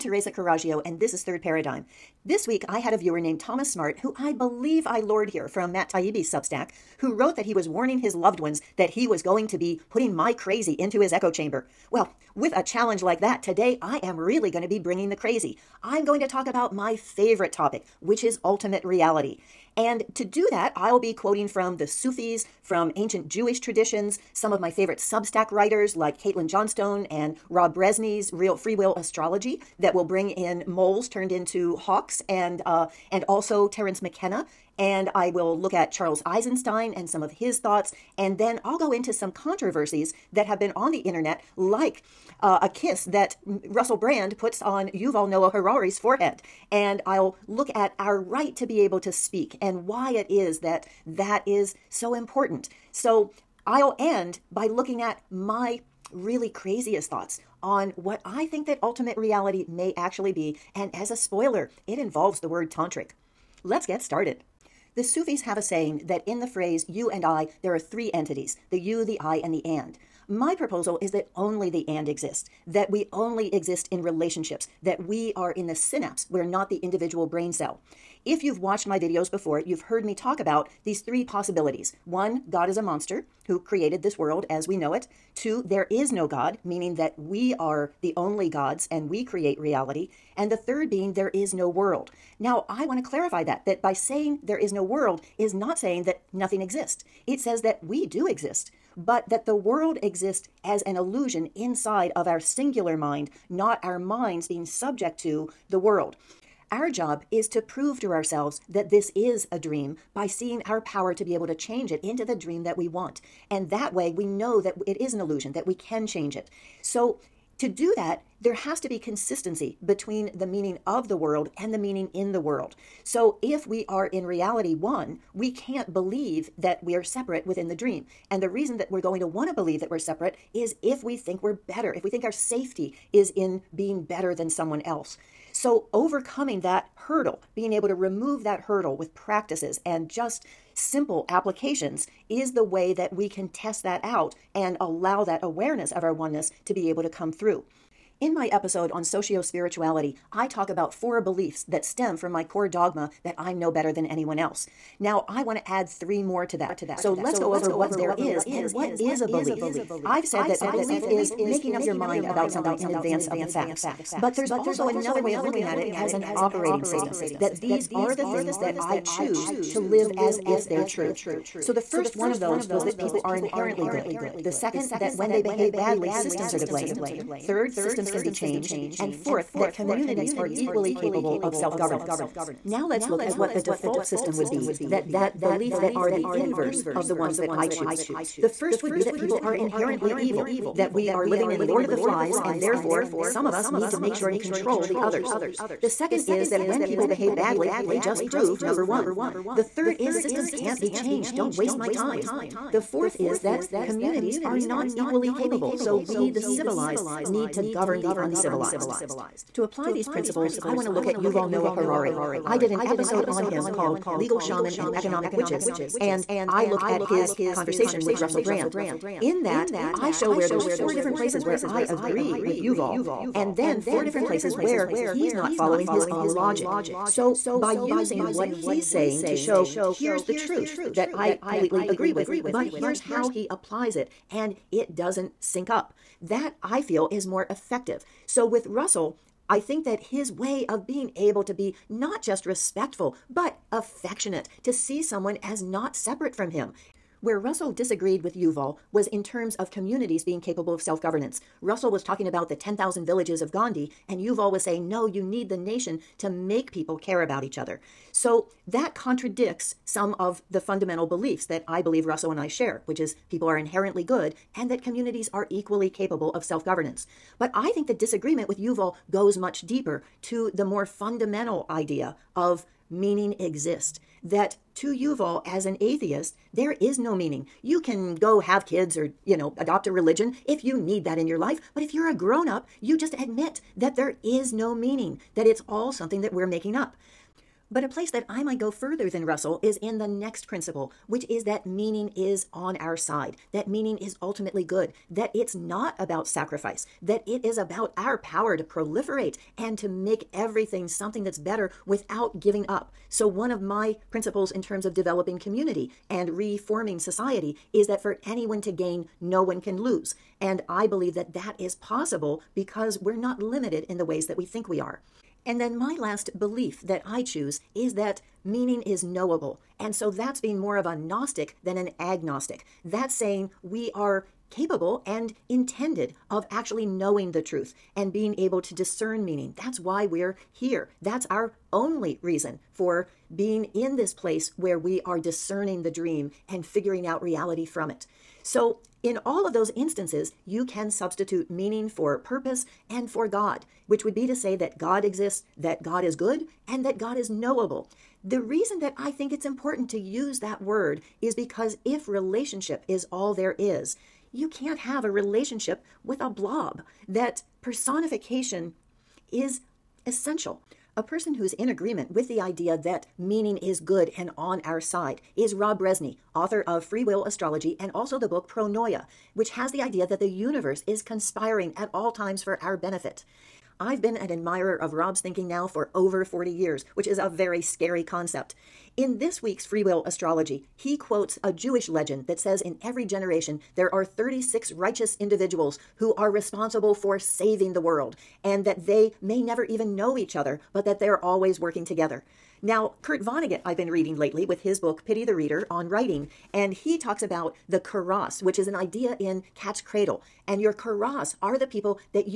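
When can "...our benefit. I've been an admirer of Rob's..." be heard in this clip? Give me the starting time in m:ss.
6:12.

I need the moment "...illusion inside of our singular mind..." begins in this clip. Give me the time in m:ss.
1:40.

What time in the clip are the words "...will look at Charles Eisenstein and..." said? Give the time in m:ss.
0:35.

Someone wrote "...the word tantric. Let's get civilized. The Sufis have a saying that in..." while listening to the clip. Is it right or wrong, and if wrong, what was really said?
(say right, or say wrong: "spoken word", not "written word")
wrong: "started", not "civilized".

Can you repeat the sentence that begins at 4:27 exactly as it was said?
But I think the disagreement with Yuval goes much deeper to the more fundamental idea of meaning exist.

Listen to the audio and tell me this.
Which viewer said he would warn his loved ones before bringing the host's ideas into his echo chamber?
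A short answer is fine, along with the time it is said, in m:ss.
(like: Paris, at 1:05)
Thomas Smart, at 0:03.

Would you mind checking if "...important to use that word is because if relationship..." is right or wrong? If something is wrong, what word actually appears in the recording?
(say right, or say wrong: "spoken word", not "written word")
right.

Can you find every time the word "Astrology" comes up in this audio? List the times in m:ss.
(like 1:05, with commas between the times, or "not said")
0:28, 6:07, 6:20.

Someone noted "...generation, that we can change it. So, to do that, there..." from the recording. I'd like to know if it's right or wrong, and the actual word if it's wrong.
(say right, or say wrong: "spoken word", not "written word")
wrong: "illusion", not "generation".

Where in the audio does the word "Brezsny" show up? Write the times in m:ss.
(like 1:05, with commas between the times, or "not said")
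0:27, 6:05.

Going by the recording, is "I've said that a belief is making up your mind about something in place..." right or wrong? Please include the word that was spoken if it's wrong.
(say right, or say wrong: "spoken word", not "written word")
wrong: "advance", not "place".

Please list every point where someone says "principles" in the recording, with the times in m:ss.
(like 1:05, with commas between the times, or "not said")
3:30, 4:50, 5:04.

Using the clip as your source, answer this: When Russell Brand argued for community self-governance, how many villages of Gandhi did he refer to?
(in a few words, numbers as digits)
10,000.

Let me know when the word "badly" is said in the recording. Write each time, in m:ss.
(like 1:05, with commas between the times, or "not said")
2:55, 3:17.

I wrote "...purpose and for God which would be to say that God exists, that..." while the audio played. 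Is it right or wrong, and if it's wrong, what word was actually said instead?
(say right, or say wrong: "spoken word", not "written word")
right.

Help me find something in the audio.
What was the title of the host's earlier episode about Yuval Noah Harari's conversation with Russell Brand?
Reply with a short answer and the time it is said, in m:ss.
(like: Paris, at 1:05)
Legal Shaman and Economic Witches, at 3:34.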